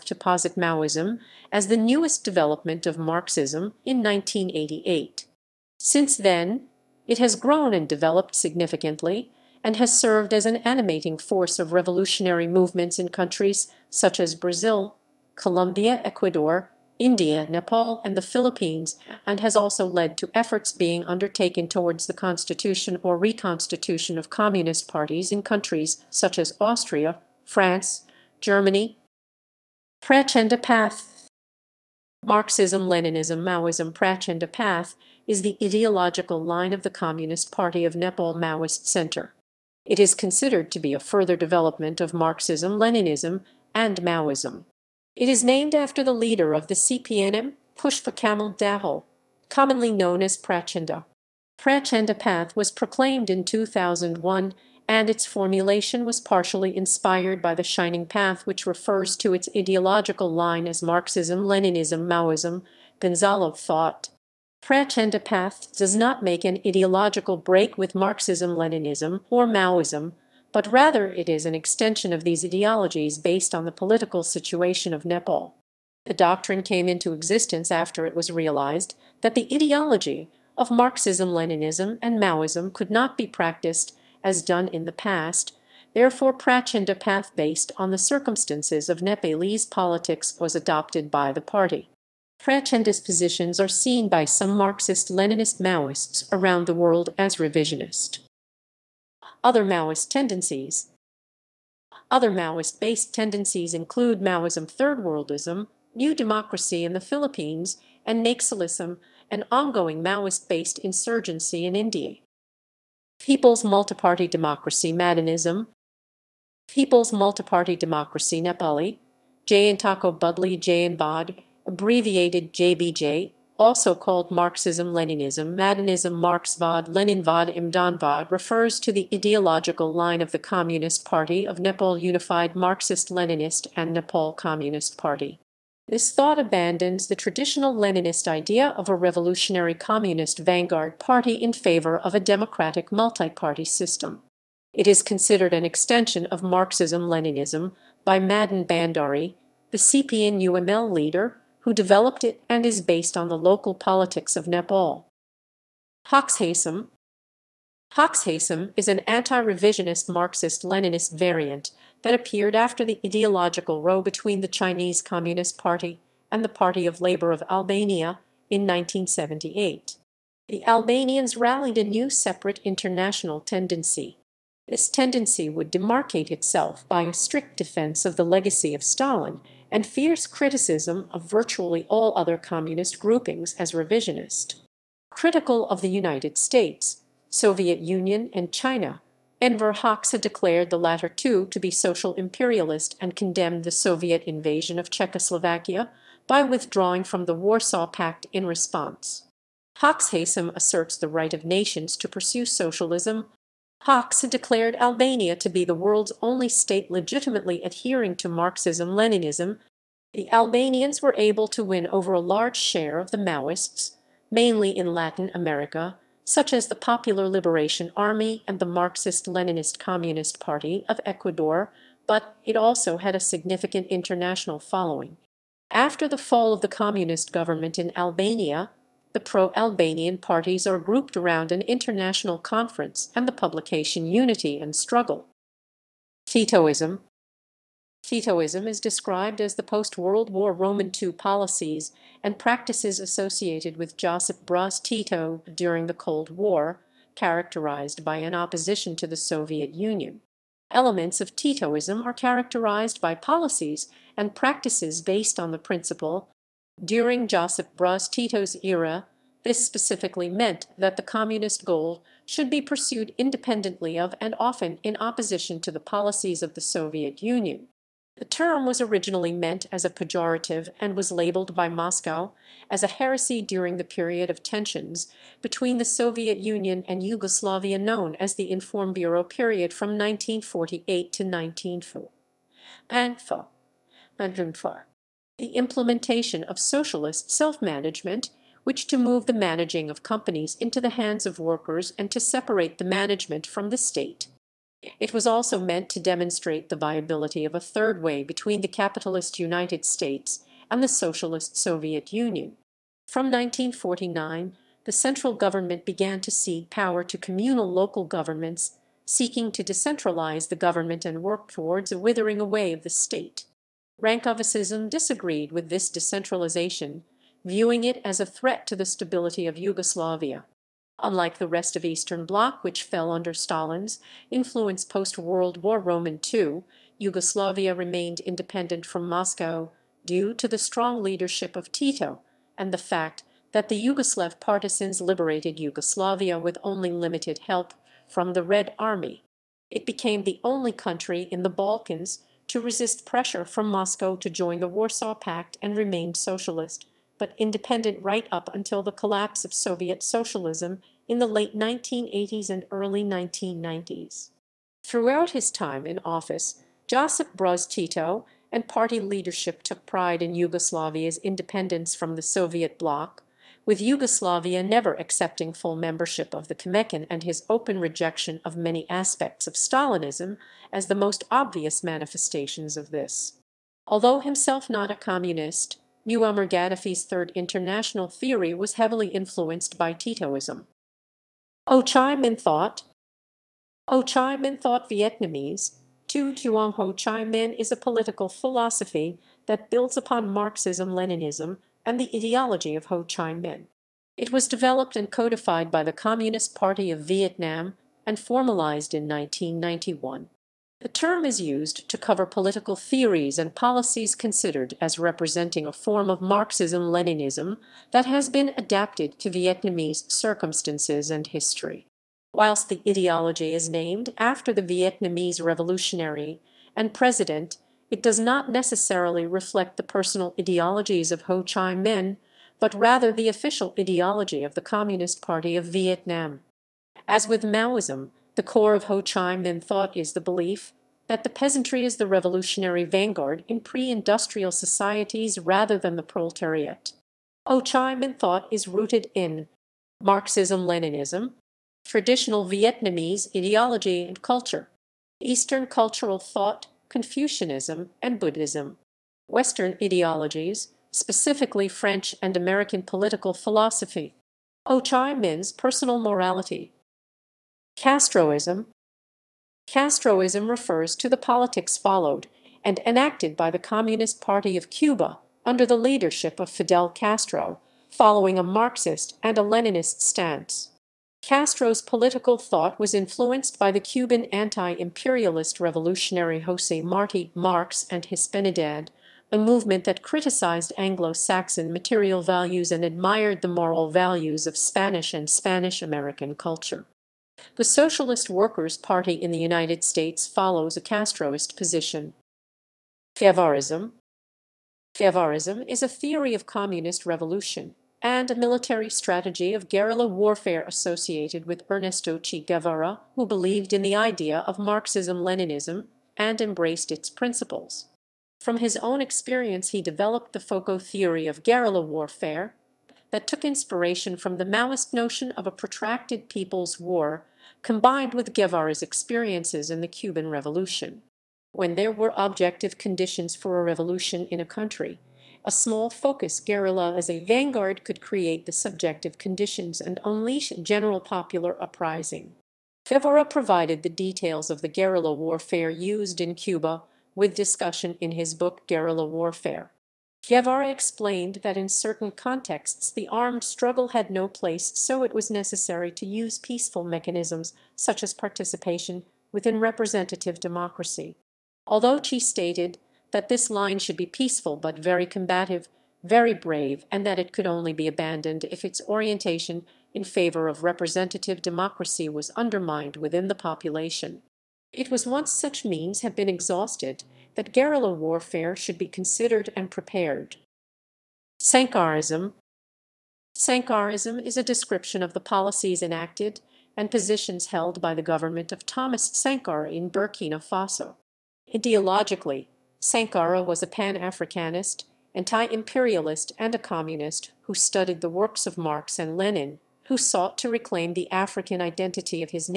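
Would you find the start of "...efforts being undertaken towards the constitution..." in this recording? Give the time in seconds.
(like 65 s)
20 s.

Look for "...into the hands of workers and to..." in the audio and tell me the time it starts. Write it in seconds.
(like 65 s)
290 s.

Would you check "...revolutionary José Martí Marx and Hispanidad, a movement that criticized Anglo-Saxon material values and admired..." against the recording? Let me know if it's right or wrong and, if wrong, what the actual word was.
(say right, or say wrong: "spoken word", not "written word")
right.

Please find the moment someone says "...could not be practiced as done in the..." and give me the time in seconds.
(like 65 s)
82 s.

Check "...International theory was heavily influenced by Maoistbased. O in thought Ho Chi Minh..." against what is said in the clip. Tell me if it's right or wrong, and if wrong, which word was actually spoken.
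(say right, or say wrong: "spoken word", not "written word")
wrong: "Titoism", not "Maoistbased".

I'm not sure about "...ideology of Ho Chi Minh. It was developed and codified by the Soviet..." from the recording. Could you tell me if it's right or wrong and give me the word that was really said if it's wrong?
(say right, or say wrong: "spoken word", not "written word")
wrong: "Communist", not "Soviet".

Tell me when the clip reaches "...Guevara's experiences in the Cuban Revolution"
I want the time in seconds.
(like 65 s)
518 s.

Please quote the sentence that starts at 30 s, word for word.
Prachanda Path Marxism, Leninism, Maoism, Prachanda Path is the ideological line of the Communist Party of Nepal Maoist Center.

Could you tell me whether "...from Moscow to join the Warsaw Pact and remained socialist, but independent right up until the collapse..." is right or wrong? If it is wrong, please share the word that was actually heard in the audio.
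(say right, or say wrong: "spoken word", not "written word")
right.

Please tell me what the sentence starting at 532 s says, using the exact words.
Guevara provided the details of the guerrilla warfare used in Cuba with discussion in his book Guerrilla Warfare.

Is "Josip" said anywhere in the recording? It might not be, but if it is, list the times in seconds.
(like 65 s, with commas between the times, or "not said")
243 s, 257 s, 356 s.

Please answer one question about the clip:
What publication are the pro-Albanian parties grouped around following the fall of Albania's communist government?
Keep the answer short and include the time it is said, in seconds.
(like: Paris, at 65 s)
Unity and Struggle, at 234 s.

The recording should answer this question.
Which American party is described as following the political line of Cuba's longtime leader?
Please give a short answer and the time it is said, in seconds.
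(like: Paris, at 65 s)
Socialist Workers' Party, at 487 s.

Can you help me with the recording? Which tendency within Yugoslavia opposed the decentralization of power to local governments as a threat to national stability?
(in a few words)
Rankovicism.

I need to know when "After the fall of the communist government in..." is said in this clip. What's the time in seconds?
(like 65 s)
225 s.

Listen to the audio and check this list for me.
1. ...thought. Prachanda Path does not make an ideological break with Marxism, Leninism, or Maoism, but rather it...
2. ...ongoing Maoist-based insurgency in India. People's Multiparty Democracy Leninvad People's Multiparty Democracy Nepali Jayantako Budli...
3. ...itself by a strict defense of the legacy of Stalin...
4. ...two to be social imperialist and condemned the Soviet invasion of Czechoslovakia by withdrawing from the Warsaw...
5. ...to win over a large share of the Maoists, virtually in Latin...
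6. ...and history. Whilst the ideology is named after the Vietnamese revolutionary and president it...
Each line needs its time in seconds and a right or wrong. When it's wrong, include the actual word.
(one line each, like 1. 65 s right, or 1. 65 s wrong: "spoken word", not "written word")
1. 63 s right
2. 109 s wrong: "Madanism", not "Leninvad"
3. 176 s right
4. 191 s right
5. 211 s wrong: "mainly", not "virtually"
6. 411 s right.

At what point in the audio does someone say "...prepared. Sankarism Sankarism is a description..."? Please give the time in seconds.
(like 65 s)
569 s.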